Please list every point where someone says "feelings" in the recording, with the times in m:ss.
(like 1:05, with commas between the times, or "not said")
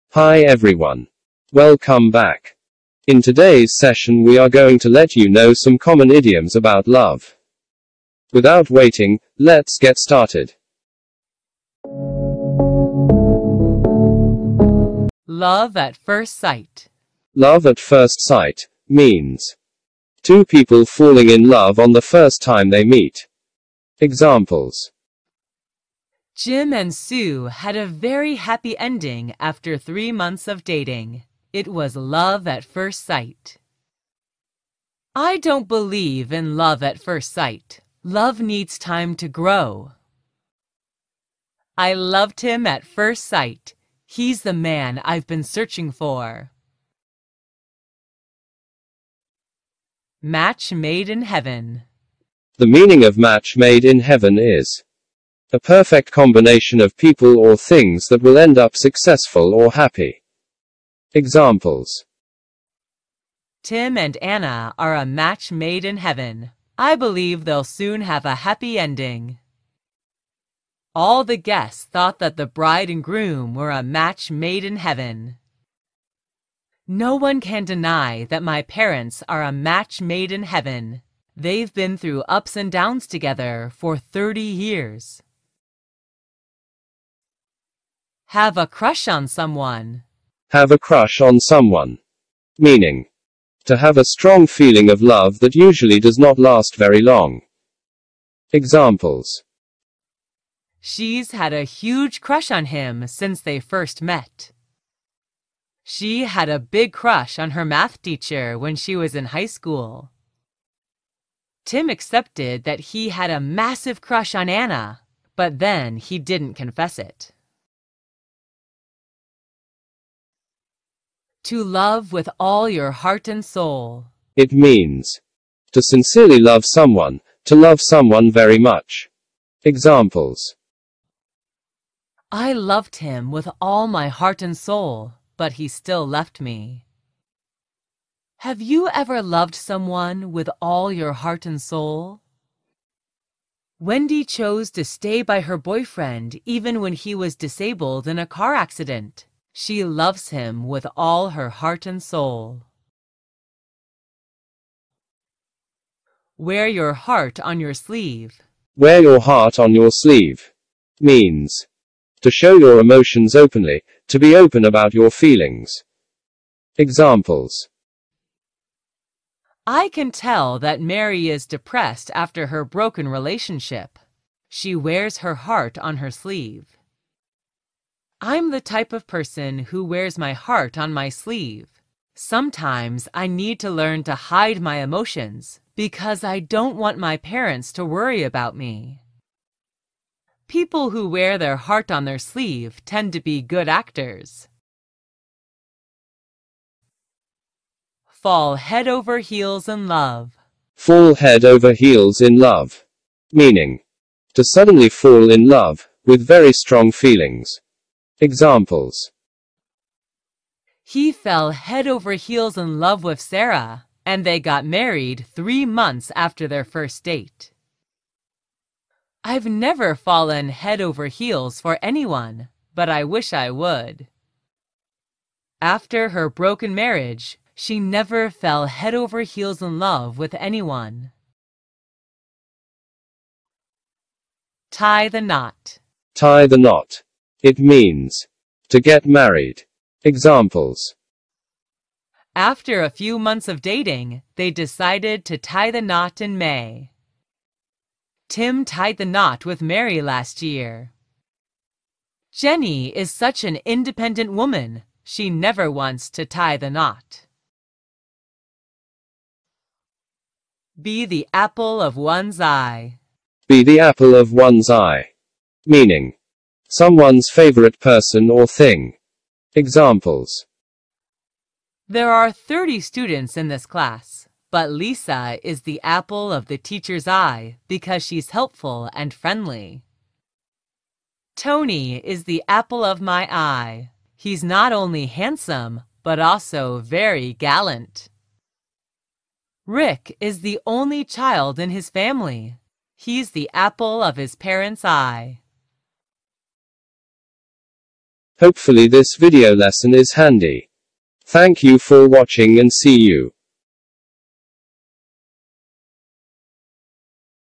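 1:34, 2:45, 3:26.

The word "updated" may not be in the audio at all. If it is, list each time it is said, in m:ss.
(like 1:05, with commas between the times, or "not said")
not said.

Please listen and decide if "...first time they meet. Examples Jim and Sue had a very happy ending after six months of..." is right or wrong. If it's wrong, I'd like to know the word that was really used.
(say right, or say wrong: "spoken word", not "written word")
wrong: "three", not "six".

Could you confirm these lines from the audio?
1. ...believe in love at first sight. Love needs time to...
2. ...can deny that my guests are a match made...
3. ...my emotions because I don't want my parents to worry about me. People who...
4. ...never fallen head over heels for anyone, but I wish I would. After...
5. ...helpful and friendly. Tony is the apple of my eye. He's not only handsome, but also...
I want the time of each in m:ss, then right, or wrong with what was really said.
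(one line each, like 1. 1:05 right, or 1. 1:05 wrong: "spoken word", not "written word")
1. 0:35 right
2. 1:17 wrong: "parents", not "guests"
3. 3:04 right
4. 3:39 right
5. 4:38 right.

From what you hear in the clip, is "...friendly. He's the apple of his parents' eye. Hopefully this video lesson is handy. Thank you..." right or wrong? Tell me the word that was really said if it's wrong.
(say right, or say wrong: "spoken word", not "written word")
wrong: "family", not "friendly".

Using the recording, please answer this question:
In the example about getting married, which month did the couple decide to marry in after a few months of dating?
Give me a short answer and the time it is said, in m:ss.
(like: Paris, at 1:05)
May, at 4:06.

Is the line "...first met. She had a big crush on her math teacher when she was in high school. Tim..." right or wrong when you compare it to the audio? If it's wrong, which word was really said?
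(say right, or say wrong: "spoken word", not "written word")
right.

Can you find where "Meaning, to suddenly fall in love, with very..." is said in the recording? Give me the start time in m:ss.
3:23.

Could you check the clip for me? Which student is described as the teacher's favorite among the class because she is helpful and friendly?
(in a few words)
Lisa.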